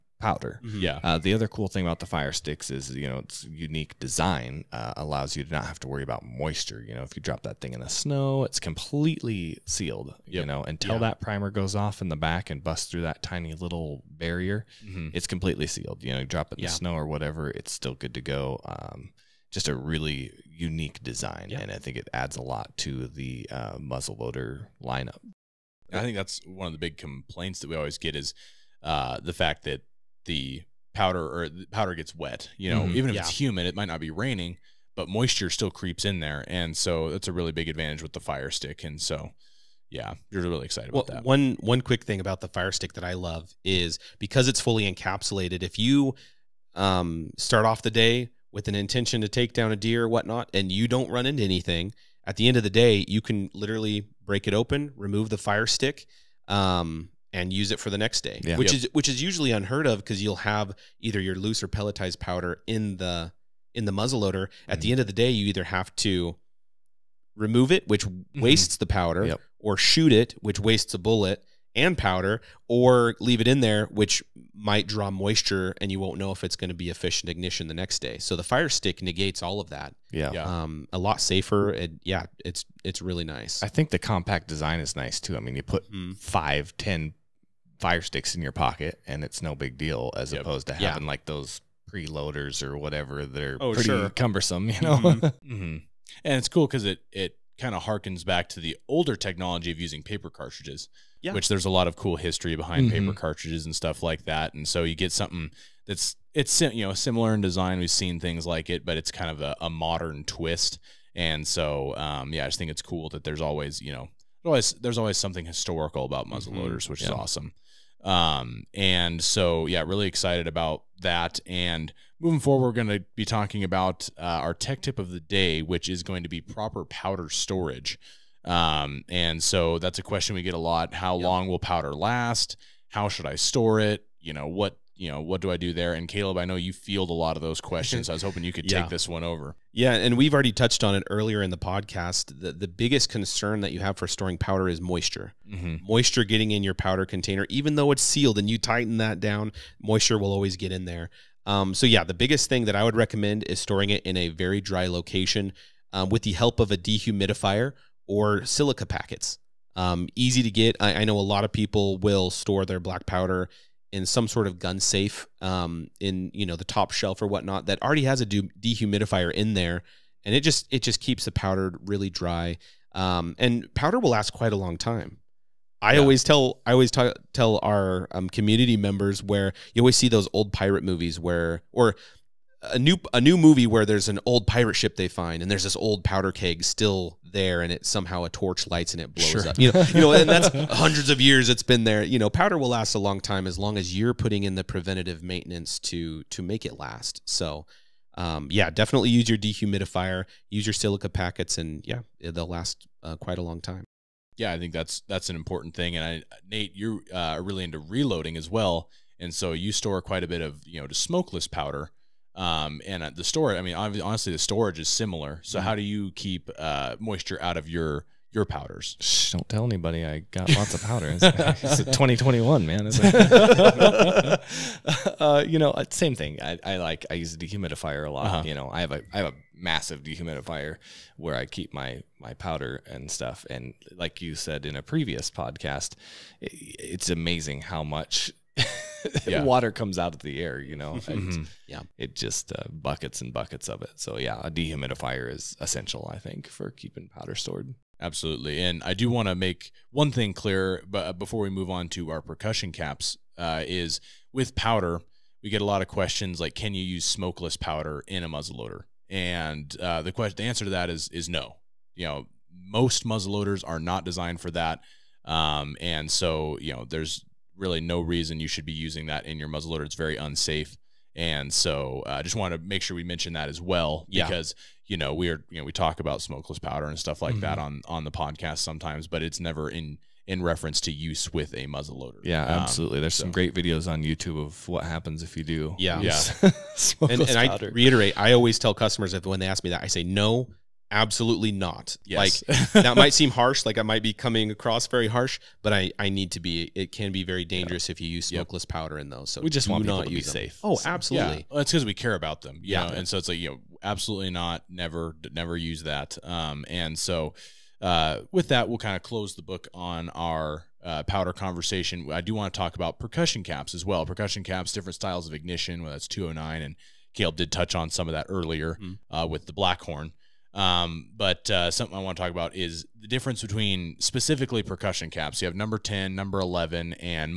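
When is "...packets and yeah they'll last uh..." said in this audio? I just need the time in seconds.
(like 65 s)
201 s.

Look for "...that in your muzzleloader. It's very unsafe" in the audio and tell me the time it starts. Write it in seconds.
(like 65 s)
269 s.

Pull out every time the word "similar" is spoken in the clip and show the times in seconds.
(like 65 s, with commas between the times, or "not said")
106 s, 214 s.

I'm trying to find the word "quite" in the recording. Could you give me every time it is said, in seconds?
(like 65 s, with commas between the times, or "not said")
174 s, 203 s, 210 s.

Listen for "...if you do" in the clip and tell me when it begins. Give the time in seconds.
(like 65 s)
285 s.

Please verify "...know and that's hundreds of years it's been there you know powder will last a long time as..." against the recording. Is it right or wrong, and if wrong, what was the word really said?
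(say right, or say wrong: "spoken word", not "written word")
right.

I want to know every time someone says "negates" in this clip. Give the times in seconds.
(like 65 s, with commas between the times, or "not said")
79 s.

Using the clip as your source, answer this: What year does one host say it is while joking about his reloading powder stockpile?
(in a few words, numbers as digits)
2021.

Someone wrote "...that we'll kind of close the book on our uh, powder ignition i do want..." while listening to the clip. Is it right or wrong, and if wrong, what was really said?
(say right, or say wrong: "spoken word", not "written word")
wrong: "conversation", not "ignition".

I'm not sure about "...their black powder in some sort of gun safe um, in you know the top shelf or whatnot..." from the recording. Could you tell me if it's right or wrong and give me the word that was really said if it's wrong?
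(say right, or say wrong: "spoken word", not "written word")
right.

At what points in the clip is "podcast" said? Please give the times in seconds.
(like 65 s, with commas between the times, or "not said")
141 s, 235 s, 278 s.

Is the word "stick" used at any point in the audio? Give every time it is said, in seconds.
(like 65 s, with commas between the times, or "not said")
2 s, 38 s, 42 s, 55 s, 78 s, 88 s.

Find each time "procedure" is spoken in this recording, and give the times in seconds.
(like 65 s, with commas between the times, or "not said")
not said.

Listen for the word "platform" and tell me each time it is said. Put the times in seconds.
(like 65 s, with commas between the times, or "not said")
not said.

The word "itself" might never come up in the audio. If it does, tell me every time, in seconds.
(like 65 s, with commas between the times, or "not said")
not said.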